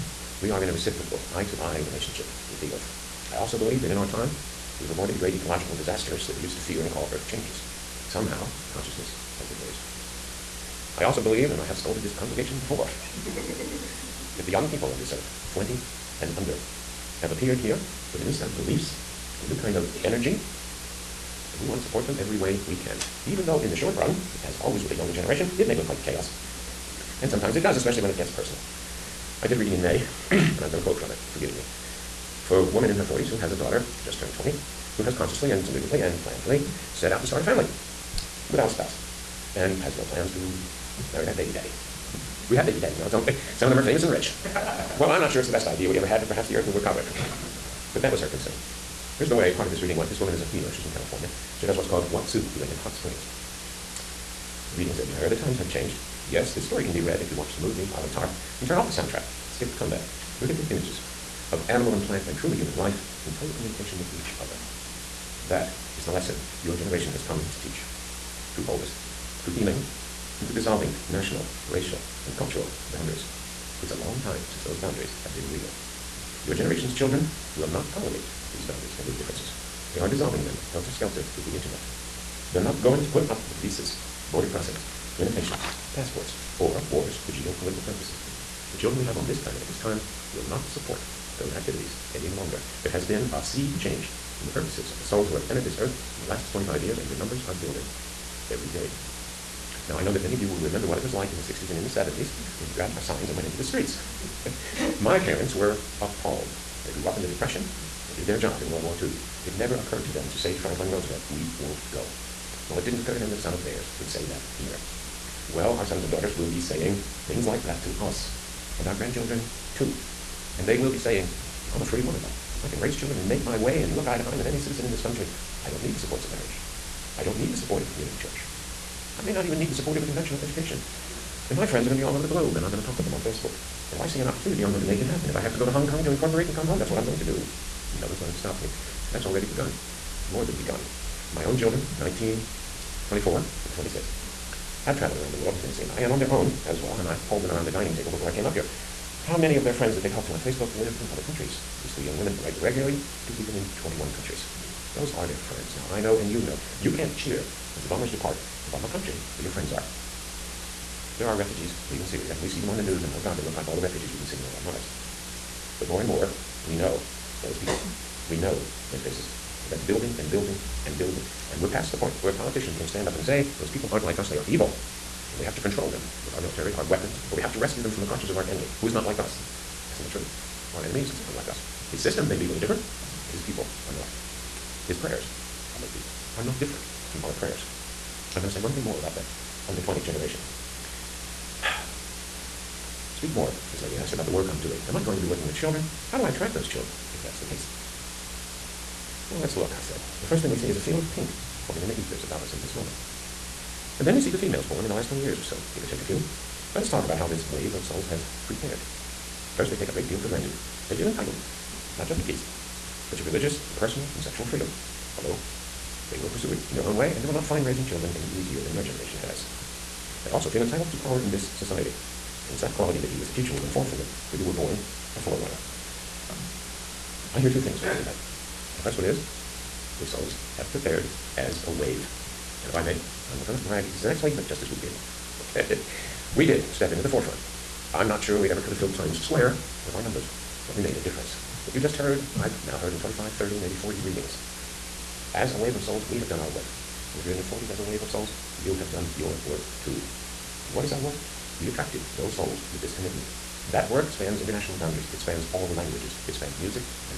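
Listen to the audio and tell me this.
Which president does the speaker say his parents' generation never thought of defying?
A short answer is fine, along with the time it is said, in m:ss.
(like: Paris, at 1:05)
Franklin Roosevelt, at 1:50.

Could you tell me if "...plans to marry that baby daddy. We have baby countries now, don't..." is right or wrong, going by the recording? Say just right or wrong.
wrong.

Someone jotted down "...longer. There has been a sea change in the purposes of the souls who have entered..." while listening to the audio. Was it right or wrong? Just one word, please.
right.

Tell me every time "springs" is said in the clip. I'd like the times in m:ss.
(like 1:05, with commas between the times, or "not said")
0:52.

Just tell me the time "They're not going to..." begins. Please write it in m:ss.
1:22.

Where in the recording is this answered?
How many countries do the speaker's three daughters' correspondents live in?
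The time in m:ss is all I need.
2:33.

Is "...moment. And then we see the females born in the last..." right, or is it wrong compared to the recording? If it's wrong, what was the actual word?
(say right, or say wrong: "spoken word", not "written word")
right.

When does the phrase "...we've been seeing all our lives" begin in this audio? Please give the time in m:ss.
2:44.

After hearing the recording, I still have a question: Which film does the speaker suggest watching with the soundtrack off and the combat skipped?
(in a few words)
Avatar.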